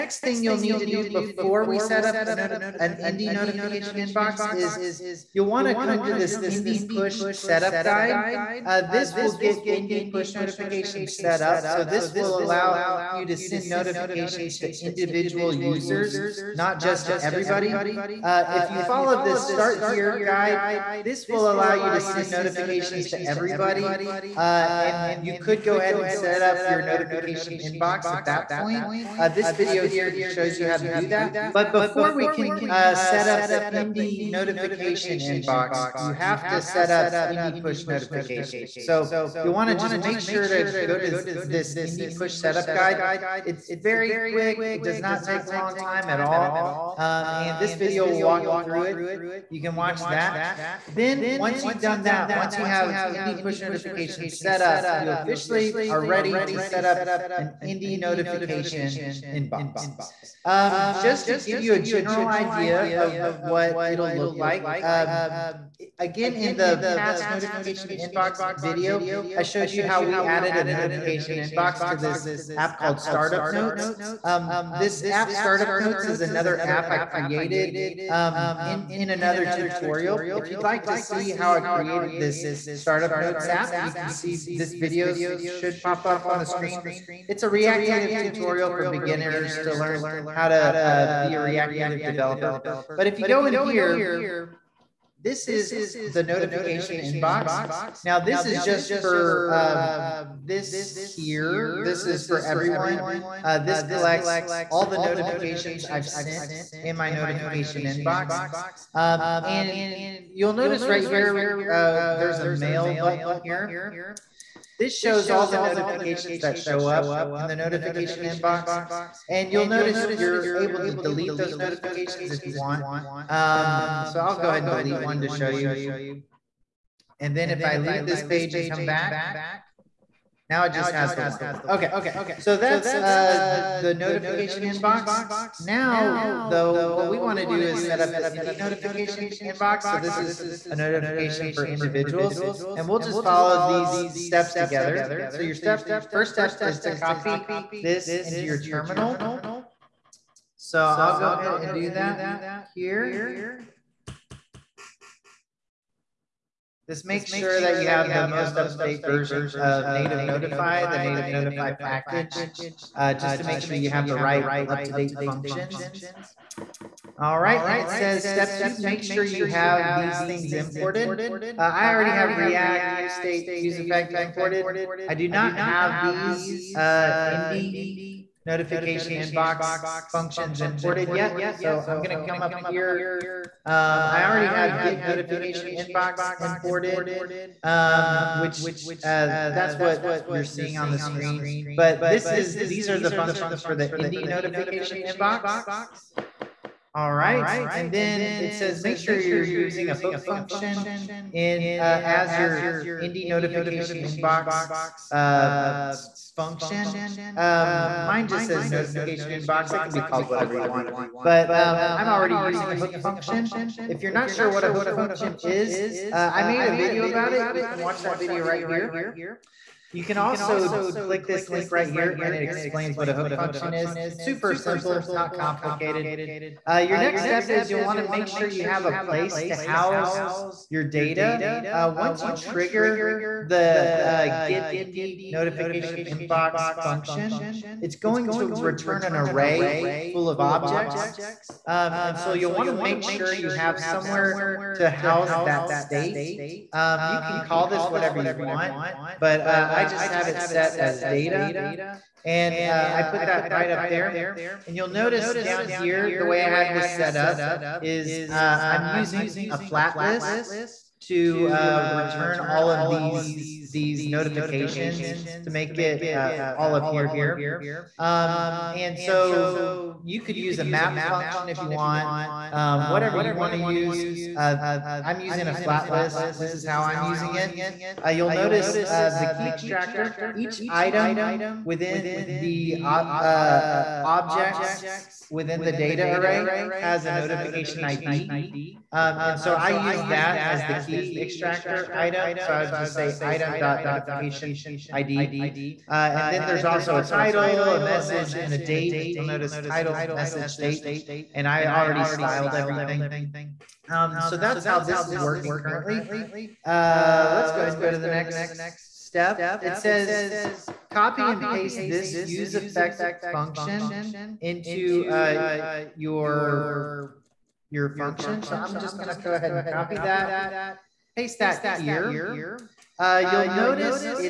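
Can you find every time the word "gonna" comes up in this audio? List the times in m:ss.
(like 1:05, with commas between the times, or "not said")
3:02, 5:18.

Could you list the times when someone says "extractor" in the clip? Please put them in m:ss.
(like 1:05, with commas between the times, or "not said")
4:39, 4:51.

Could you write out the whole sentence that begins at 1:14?
Um, this app, Startup Notes, is another app I created um, in, in another tutorial.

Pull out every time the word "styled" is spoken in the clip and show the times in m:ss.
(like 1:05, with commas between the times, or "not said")
5:02.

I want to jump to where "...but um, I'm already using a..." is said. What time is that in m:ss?
3:31.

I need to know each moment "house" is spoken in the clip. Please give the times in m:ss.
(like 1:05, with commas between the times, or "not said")
3:49, 4:04.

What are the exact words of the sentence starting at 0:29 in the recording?
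Uh, this video here shows you how to do that.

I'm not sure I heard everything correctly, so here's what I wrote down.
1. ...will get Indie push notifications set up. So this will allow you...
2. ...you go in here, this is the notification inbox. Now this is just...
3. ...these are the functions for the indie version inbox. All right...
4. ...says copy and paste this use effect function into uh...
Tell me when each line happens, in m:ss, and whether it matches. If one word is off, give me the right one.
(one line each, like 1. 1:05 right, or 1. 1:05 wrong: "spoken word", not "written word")
1. 0:09 right
2. 1:33 right
3. 3:12 wrong: "notification", not "version"
4. 5:09 right.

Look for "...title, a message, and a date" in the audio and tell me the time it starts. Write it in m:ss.
4:57.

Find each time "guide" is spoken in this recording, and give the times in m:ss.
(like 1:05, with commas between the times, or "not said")
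0:07, 0:20, 0:42.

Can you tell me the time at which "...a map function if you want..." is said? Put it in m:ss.
4:30.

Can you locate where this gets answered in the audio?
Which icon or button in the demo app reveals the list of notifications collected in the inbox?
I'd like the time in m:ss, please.
1:52.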